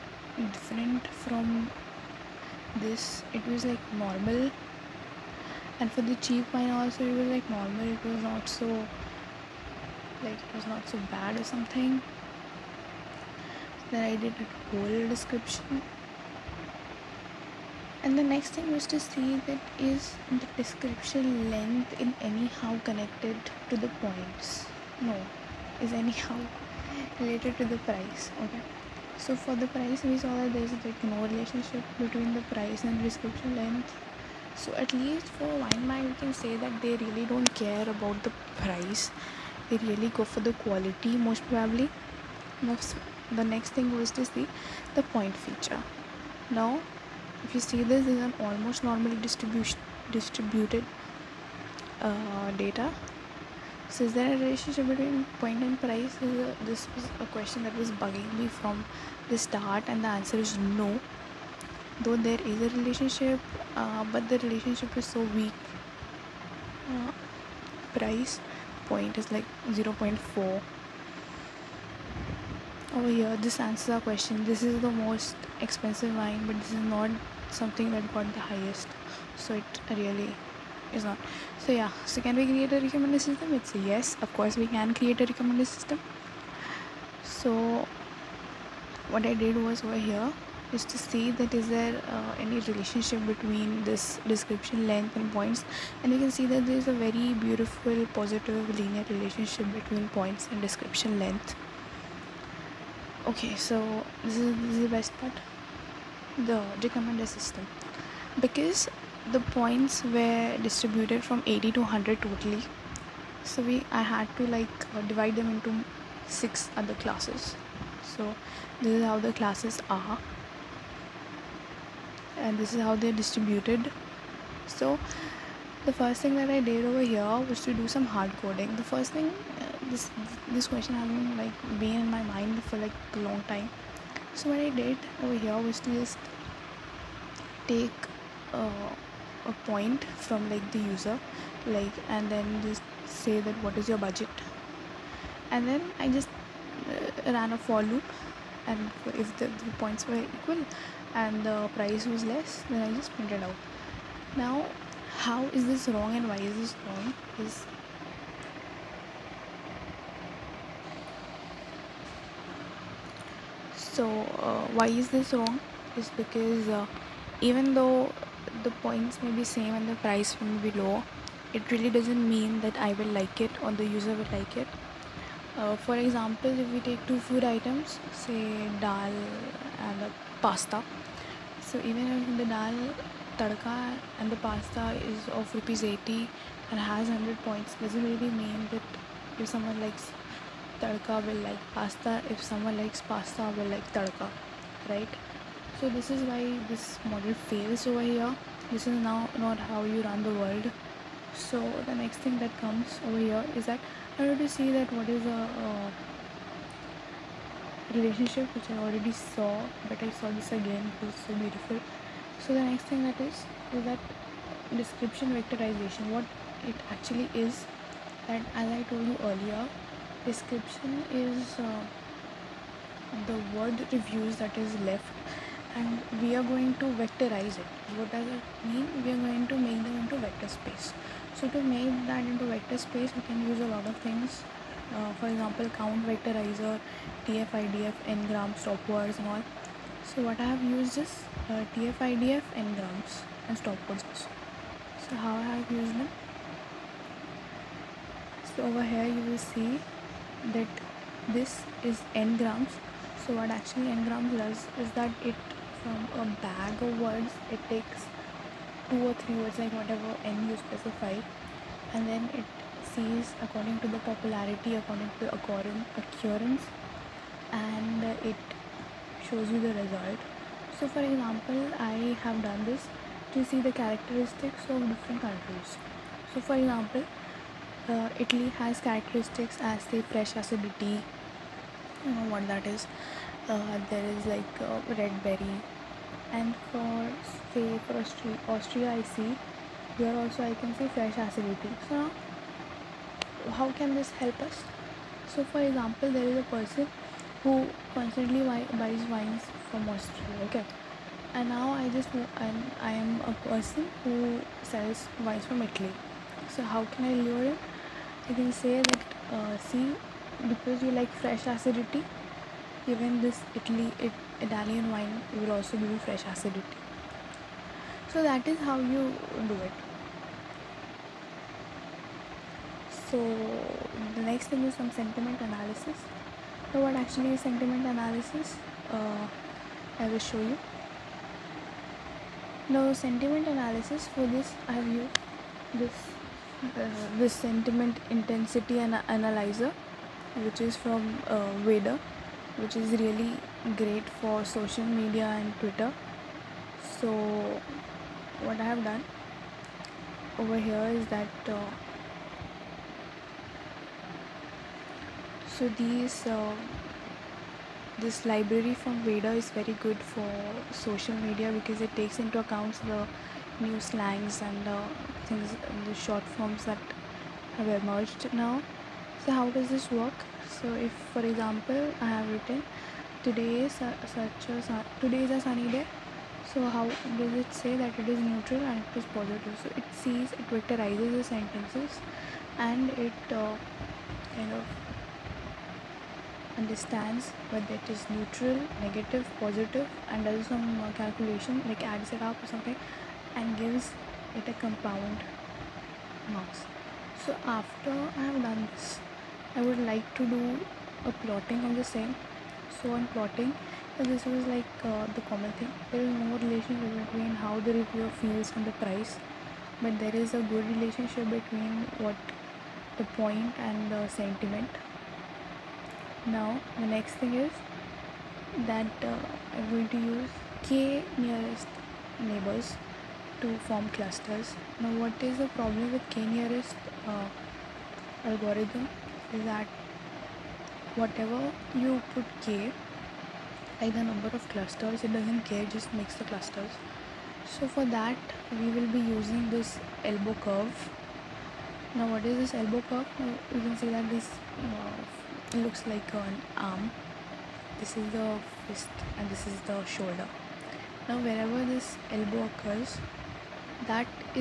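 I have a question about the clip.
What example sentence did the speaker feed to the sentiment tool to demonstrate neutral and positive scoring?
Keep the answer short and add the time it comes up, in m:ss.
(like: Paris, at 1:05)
today is a sunny day, at 6:15.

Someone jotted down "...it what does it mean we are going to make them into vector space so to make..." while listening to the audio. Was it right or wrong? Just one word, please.
right.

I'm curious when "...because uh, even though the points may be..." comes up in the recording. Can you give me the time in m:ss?
2:46.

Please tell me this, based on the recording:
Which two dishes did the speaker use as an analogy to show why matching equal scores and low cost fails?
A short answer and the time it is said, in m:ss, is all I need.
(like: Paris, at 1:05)
dal and pasta, at 2:58.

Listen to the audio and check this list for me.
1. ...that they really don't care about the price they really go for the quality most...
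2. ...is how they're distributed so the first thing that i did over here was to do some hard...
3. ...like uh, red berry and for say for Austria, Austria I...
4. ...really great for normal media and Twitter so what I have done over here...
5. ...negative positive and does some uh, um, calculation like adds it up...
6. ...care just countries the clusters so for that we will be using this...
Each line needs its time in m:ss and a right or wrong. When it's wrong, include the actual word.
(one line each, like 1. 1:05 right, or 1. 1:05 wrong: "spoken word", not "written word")
1. 0:36 right
2. 2:02 right
3. 4:44 right
4. 5:42 wrong: "social", not "normal"
5. 6:28 right
6. 7:15 wrong: "makes", not "countries".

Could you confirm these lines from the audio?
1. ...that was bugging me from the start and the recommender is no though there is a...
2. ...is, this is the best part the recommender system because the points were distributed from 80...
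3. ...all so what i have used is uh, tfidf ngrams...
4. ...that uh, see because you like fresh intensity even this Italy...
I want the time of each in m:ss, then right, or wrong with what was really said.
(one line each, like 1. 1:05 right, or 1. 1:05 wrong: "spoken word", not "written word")
1. 0:57 wrong: "answer", not "recommender"
2. 1:44 right
3. 3:59 right
4. 5:08 wrong: "acidity", not "intensity".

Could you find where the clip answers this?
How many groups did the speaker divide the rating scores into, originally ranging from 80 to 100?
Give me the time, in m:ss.
1:56.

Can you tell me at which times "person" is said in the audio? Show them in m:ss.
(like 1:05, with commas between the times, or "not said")
4:56, 5:03.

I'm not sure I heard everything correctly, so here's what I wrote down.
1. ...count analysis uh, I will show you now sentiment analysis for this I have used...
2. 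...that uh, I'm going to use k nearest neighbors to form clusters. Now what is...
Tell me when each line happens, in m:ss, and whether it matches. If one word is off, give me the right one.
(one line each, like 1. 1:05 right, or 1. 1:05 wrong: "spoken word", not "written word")
1. 5:27 wrong: "sentiment", not "count"
2. 6:58 right.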